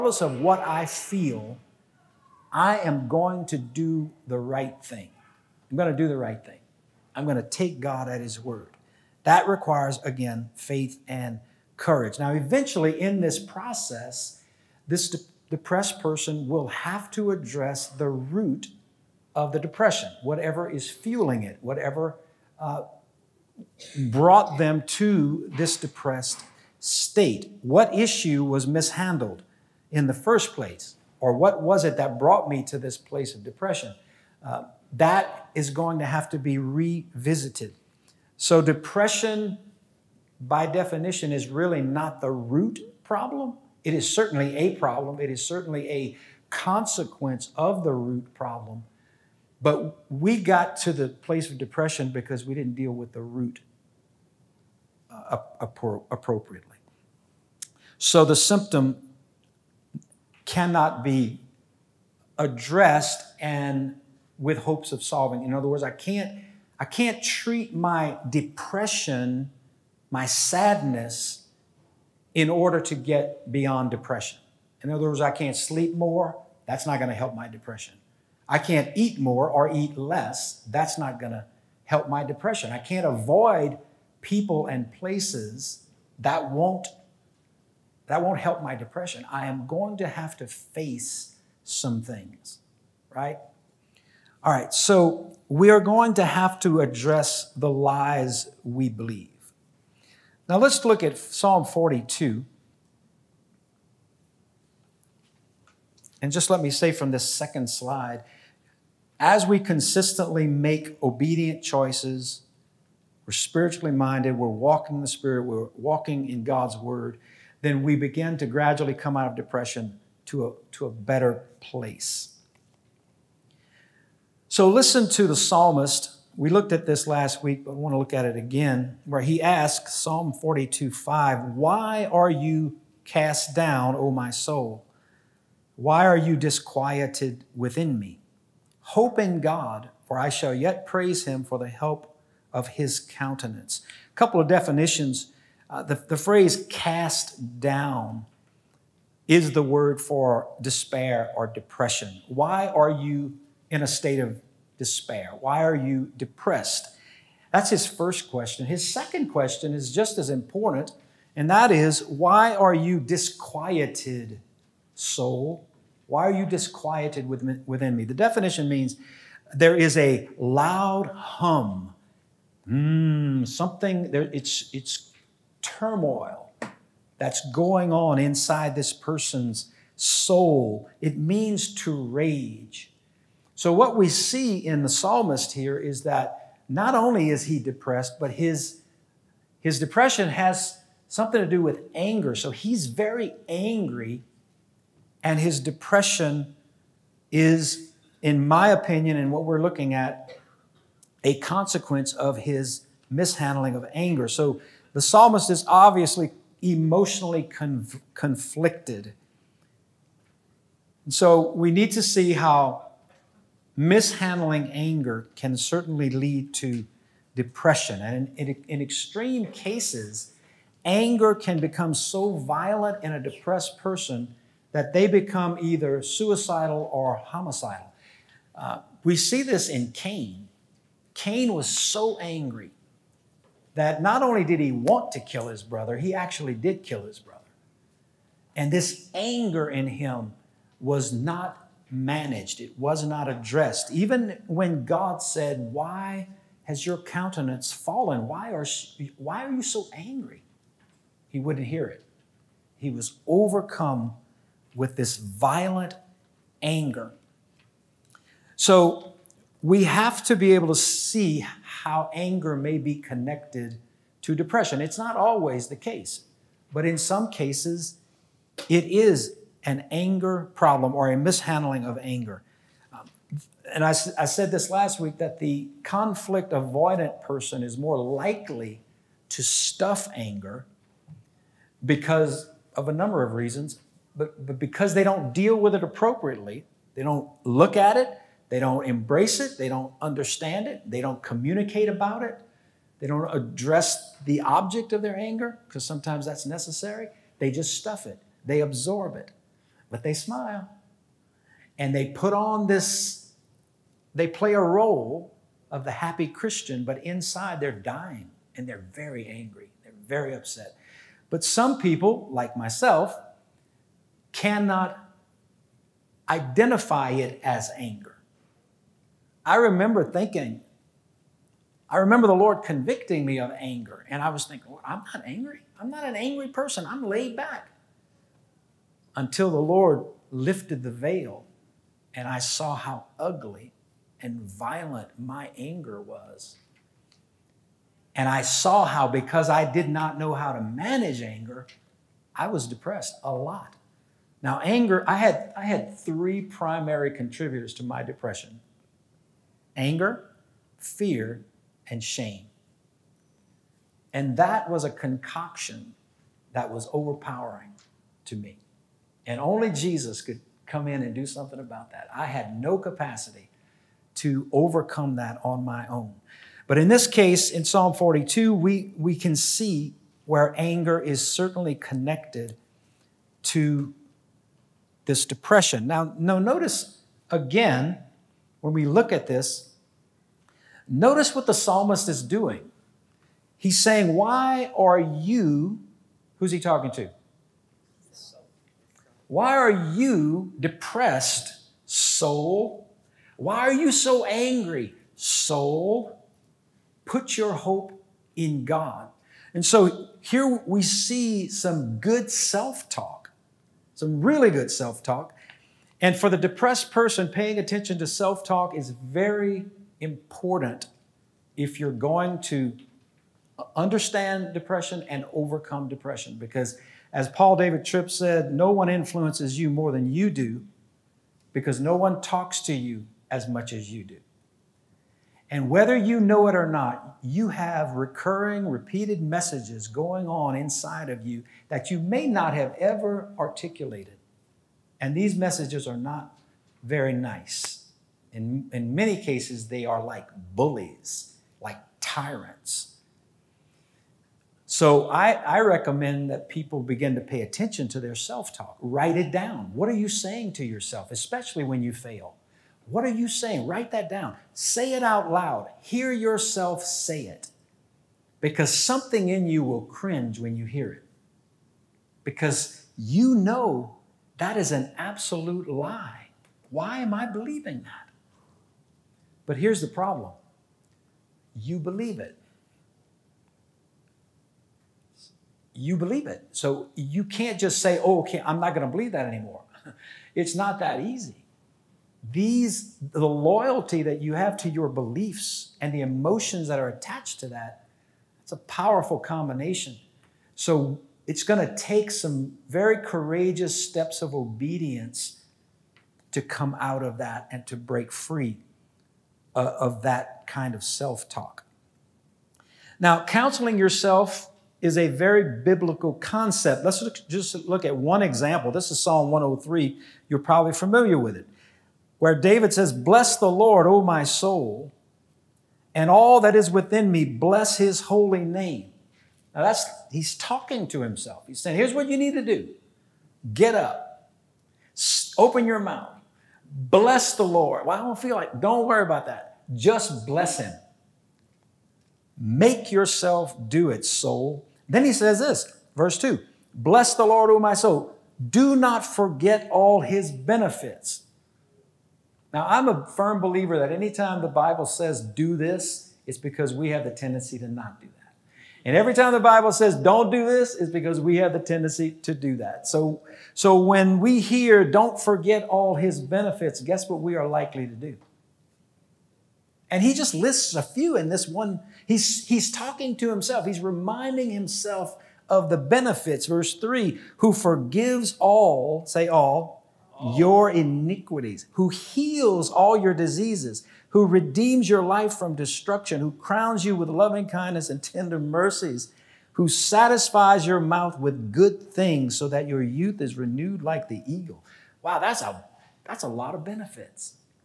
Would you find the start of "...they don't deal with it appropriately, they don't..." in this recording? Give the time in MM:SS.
04:44.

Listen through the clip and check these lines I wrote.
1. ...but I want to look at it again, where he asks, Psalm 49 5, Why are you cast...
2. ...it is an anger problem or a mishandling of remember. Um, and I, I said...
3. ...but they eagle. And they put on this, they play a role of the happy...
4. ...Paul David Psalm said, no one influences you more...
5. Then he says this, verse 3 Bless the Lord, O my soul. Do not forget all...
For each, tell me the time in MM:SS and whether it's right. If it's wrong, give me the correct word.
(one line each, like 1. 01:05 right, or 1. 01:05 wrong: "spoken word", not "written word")
1. 02:07 wrong: "42", not "49"
2. 04:28 wrong: "anger", not "remember"
3. 04:59 wrong: "smile", not "eagle"
4. 06:57 wrong: "Tripp", not "Psalm"
5. 08:54 wrong: "2", not "3".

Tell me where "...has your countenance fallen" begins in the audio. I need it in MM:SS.
04:06.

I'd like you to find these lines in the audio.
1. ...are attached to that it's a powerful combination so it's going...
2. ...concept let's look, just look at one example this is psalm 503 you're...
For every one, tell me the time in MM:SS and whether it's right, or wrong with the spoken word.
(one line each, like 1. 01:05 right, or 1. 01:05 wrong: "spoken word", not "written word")
1. 08:06 right
2. 08:26 wrong: "103", not "503".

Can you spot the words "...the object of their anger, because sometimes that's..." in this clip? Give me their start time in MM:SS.
04:54.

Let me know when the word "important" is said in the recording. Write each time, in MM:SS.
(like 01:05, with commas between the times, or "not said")
02:40, 06:49.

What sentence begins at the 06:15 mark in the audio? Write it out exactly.
Now, now notice again, when we look at this, notice what the psalmist is doing.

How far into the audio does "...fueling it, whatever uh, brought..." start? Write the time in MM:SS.
00:20.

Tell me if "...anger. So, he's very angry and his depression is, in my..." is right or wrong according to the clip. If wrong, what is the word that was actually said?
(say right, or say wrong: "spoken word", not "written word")
right.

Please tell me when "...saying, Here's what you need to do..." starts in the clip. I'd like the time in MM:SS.
08:41.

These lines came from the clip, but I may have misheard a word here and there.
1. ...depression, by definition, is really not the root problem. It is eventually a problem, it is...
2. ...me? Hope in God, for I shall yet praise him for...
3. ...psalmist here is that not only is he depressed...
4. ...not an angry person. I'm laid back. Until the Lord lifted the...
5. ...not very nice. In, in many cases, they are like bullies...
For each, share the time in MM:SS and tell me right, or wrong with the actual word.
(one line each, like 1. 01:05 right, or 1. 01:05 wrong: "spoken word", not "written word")
1. 00:38 wrong: "certainly", not "eventually"
2. 02:17 right
3. 03:04 right
4. 05:25 right
5. 07:15 right.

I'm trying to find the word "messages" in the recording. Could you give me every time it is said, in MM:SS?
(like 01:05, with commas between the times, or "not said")
07:09, 07:15.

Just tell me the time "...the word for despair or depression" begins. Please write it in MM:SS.
02:29.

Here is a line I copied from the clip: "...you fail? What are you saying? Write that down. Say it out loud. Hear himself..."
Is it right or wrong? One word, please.
wrong.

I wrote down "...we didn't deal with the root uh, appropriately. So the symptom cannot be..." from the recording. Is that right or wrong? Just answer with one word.
right.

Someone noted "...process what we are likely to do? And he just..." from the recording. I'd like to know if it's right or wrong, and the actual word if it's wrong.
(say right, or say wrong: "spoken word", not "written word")
wrong: "guess", not "process".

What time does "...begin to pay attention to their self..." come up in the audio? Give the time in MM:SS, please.
07:26.